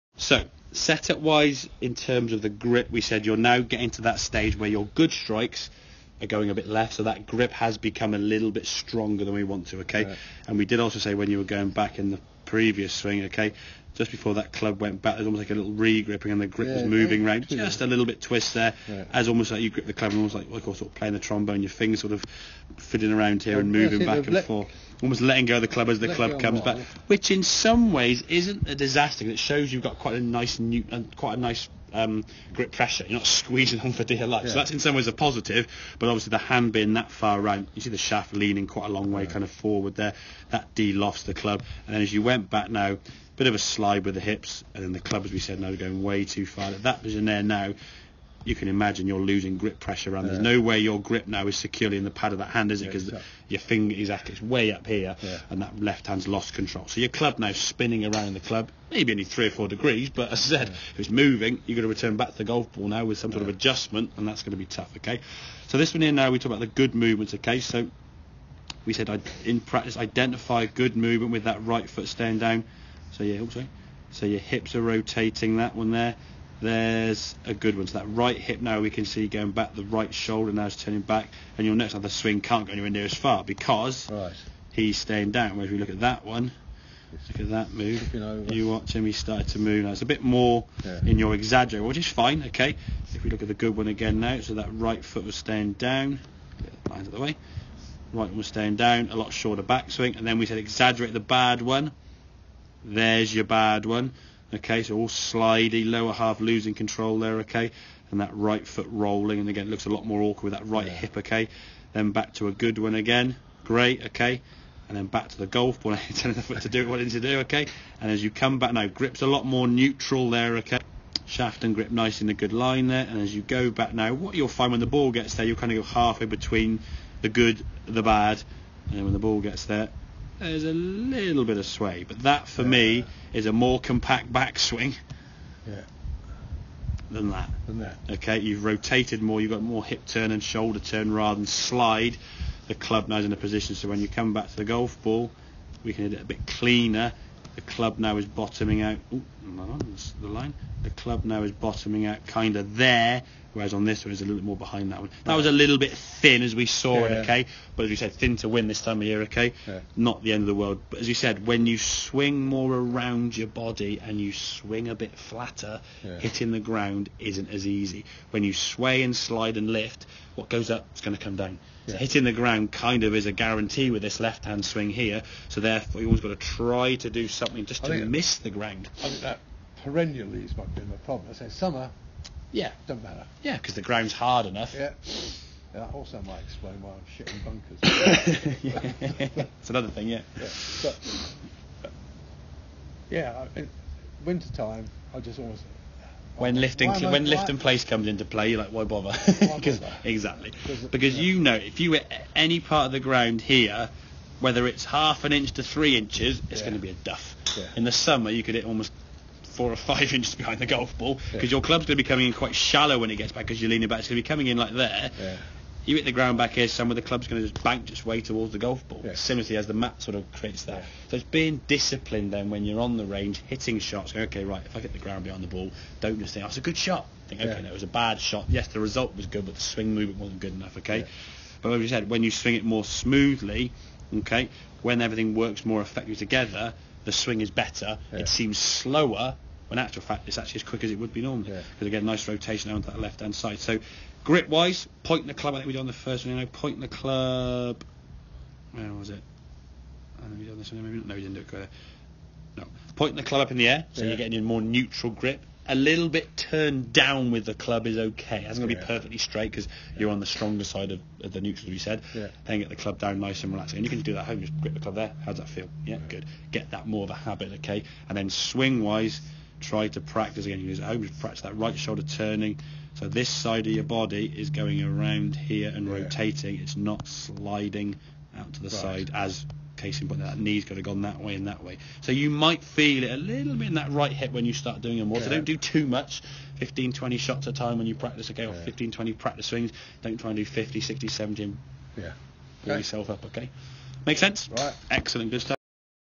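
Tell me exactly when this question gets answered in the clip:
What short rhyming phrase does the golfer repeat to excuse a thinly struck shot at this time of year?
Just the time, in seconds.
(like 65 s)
158 s.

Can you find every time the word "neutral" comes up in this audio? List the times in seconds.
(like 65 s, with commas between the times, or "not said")
119 s, 254 s, 261 s.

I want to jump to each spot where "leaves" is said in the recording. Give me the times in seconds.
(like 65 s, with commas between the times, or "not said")
180 s.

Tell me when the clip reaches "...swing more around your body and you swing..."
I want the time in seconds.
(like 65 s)
161 s.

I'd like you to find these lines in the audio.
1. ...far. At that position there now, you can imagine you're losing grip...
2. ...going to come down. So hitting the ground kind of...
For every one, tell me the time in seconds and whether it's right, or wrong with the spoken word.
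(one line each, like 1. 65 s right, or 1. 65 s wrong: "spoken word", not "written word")
1. 46 s right
2. 171 s right.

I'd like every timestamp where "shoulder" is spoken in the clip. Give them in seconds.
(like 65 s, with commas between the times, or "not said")
80 s, 140 s, 271 s.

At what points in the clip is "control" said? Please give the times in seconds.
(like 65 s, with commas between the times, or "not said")
56 s, 106 s.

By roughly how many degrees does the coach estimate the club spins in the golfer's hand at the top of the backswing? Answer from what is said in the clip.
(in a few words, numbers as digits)
3 or 4 degrees.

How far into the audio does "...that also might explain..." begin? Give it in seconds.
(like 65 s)
185 s.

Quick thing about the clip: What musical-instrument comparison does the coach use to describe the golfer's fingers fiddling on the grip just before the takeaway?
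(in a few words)
trombone.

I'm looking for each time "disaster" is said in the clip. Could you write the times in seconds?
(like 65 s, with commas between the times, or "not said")
28 s.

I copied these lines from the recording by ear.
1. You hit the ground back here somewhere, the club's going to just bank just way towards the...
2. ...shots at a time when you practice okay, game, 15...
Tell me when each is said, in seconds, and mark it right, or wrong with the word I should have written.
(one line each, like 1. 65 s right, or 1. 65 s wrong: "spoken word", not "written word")
1. 215 s right
2. 287 s right.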